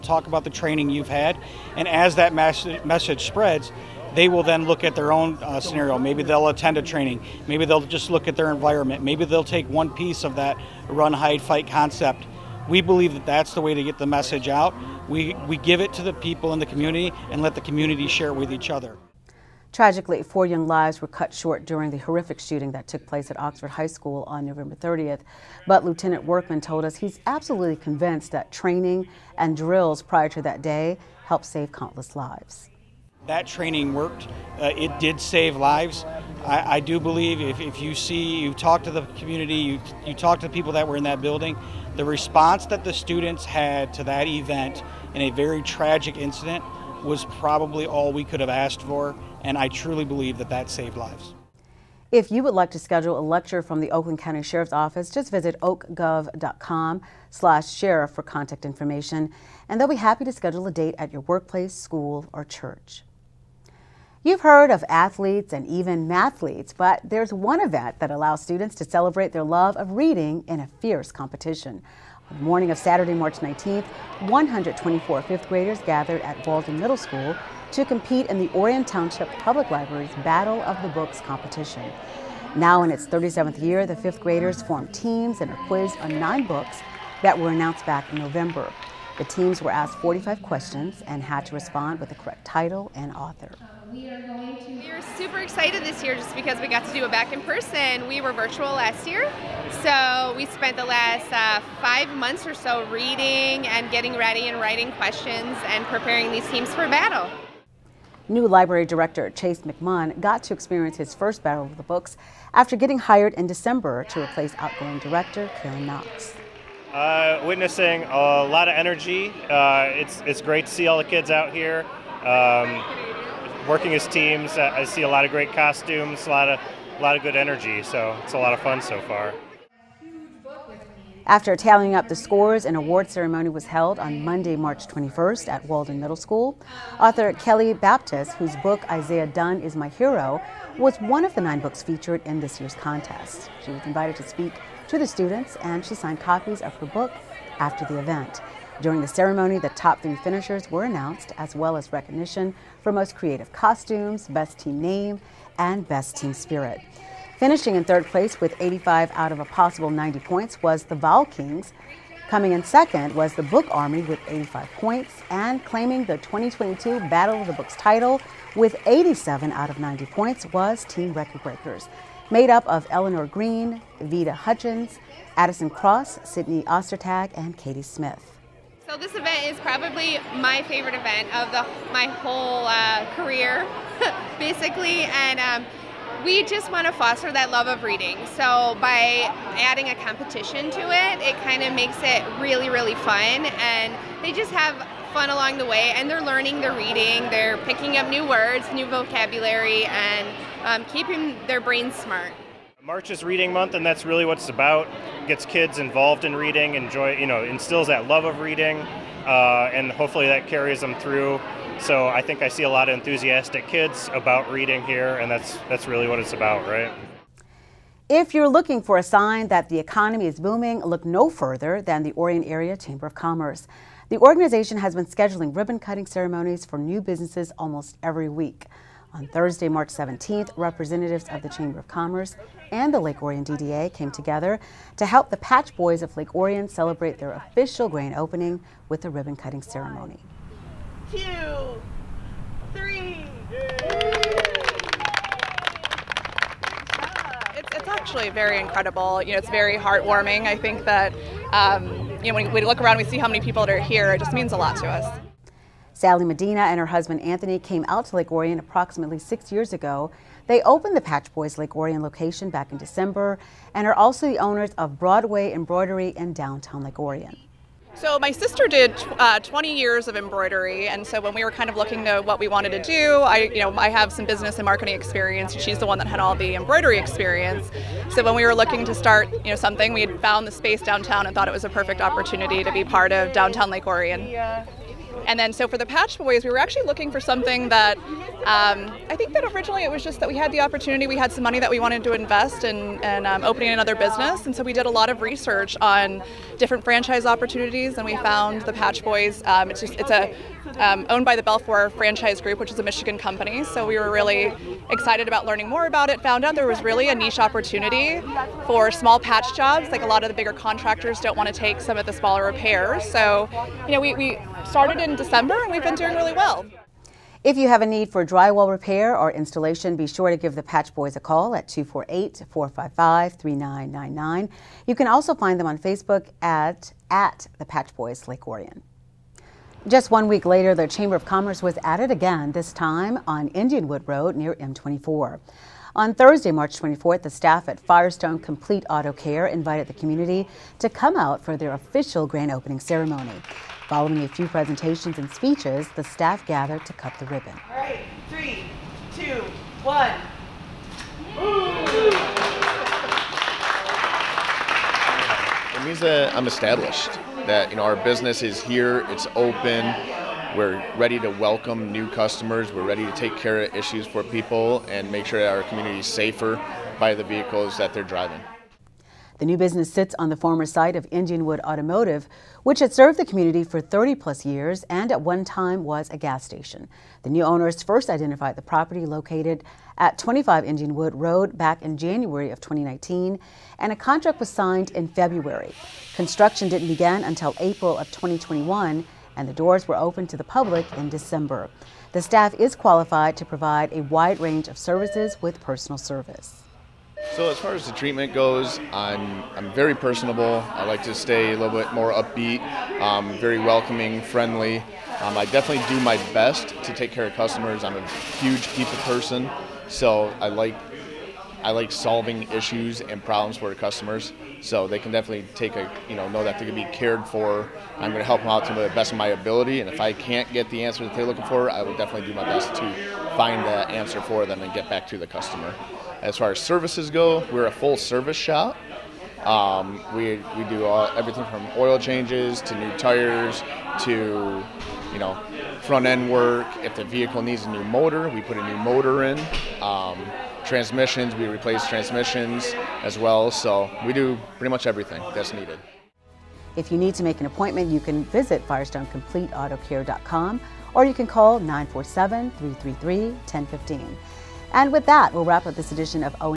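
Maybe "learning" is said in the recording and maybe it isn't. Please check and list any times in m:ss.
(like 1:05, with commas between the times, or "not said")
3:16, 5:05.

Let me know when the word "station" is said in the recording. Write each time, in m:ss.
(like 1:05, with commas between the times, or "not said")
6:16.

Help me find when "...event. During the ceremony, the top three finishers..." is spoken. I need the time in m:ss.
2:27.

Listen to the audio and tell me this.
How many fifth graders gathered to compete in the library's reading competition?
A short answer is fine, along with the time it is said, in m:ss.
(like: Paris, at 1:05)
124, at 1:14.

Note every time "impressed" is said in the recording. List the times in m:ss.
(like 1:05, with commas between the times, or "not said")
not said.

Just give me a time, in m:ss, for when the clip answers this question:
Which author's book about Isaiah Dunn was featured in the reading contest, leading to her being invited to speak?
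2:17.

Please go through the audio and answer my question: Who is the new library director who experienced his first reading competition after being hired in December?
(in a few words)
Chase McMahon.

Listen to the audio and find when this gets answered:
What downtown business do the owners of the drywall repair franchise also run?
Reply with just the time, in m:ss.
4:24.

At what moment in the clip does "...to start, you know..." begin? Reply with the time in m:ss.
4:38.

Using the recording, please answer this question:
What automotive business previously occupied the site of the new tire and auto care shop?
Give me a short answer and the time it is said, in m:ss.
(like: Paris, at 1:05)
Indianwood Automotive, at 6:11.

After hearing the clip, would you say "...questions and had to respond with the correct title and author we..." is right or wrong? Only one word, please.
right.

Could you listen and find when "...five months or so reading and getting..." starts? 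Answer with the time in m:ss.
1:41.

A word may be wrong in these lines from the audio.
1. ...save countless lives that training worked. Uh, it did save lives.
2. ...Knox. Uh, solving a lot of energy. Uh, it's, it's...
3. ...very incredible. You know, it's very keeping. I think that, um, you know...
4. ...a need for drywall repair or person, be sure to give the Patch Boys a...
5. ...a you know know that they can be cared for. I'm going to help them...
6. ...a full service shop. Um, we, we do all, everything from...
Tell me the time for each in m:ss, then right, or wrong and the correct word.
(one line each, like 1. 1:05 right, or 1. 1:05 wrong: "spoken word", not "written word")
1. 0:31 right
2. 1:55 wrong: "witnessing", not "solving"
3. 4:08 wrong: "heartwarming", not "keeping"
4. 5:17 wrong: "installation", not "person"
5. 6:55 right
6. 7:07 right.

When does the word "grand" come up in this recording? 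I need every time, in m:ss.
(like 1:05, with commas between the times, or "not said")
3:57, 5:42.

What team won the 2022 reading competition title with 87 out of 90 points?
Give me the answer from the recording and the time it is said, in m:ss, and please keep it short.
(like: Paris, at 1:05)
Team Record Breakers, at 2:50.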